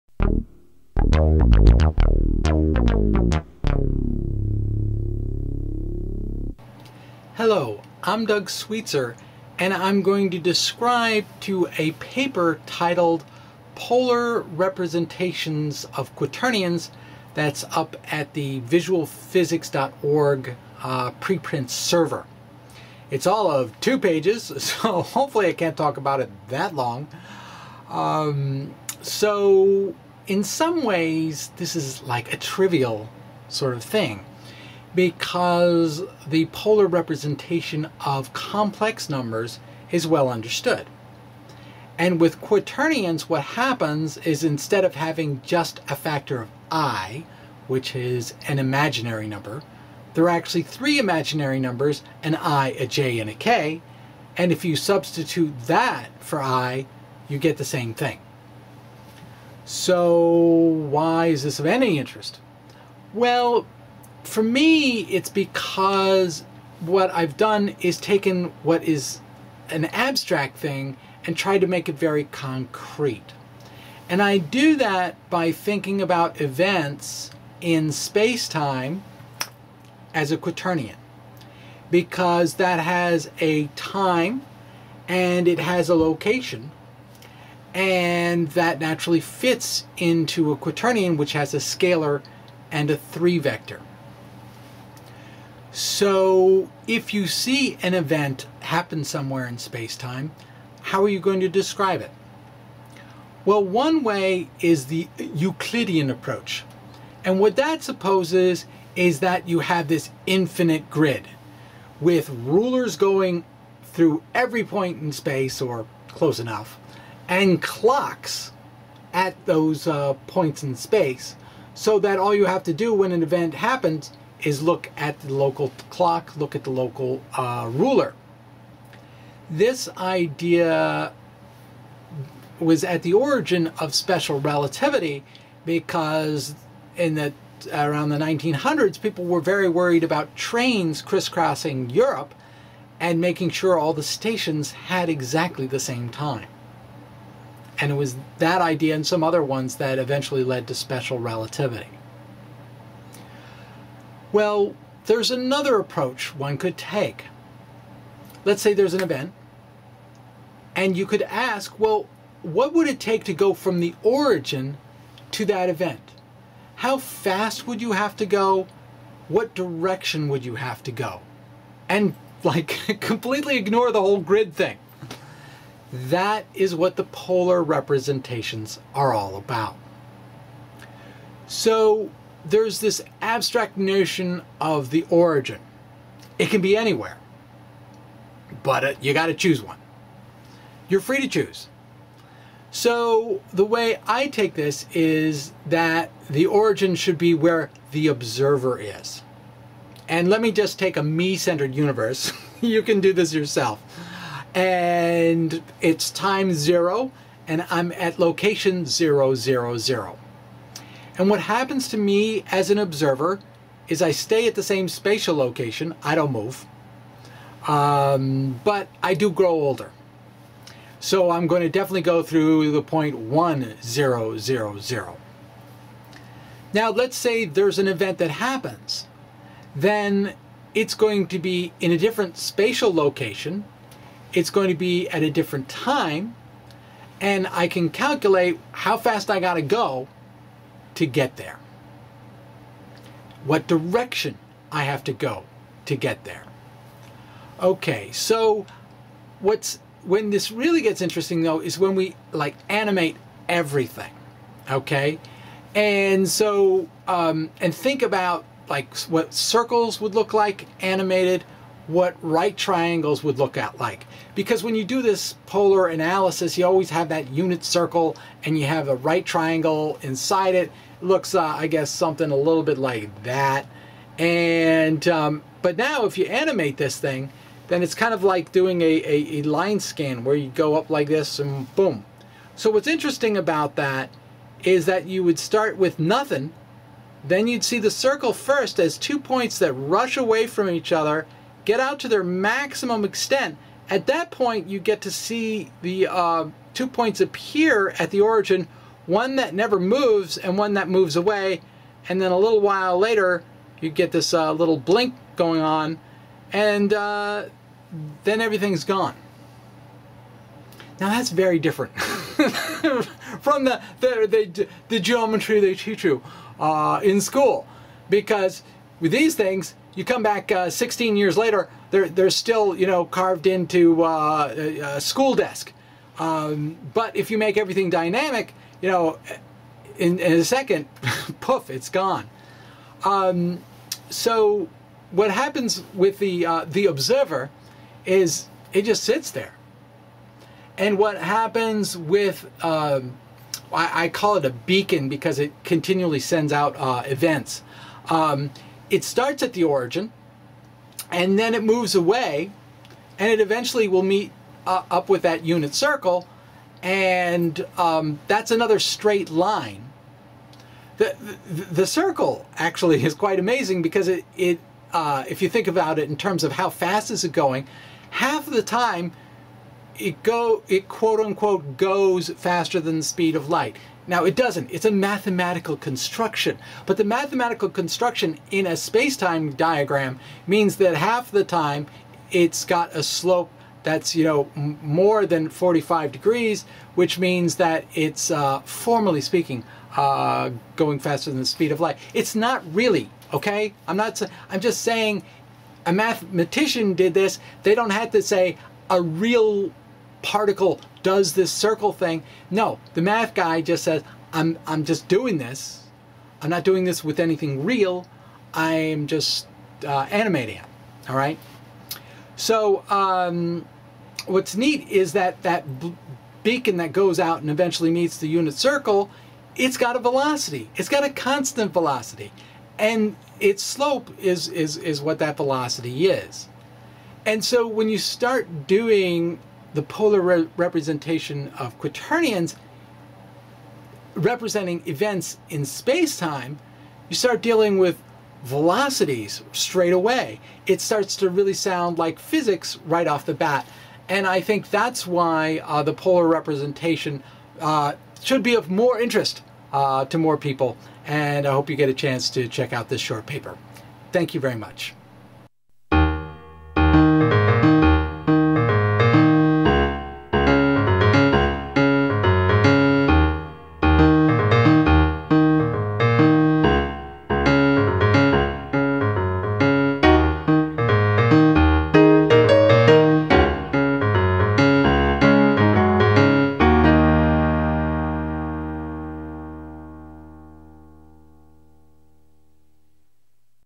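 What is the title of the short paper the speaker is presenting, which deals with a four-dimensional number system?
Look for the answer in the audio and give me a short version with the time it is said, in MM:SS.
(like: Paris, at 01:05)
Polar Representations of Quaternions, at 00:13.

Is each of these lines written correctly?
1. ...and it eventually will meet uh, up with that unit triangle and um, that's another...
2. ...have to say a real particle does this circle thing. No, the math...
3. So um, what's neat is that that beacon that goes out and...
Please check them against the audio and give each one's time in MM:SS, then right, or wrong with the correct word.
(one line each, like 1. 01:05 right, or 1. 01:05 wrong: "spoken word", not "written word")
1. 05:53 wrong: "circle", not "triangle"
2. 06:37 right
3. 06:52 right.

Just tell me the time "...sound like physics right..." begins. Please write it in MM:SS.
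07:21.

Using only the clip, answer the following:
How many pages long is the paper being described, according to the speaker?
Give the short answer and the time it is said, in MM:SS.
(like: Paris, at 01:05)
2, at 00:23.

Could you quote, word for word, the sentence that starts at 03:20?
And let me just take a me-centered universe.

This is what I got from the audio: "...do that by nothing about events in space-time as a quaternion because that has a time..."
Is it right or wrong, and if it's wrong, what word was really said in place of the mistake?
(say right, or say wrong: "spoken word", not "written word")
wrong: "thinking", not "nothing".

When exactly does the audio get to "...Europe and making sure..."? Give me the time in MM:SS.
02:21.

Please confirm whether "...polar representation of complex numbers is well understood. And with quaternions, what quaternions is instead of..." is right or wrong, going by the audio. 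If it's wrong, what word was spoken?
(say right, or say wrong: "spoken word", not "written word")
wrong: "happens", not "quaternions".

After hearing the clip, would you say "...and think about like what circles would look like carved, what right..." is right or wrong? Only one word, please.
wrong.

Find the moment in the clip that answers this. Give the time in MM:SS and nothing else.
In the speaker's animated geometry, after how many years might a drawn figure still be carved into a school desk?
05:20.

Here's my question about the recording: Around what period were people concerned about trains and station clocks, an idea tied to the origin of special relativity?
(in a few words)
the 1900s.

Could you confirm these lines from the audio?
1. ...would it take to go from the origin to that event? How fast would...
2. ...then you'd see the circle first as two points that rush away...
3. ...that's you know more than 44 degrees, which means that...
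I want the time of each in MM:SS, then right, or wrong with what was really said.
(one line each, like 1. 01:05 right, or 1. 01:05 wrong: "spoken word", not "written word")
1. 02:42 right
2. 04:47 right
3. 06:23 wrong: "45", not "44".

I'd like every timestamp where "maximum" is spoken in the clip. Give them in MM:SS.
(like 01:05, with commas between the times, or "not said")
04:52.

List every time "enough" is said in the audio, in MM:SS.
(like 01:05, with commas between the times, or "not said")
01:56.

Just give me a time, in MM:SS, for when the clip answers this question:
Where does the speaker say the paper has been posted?
00:18.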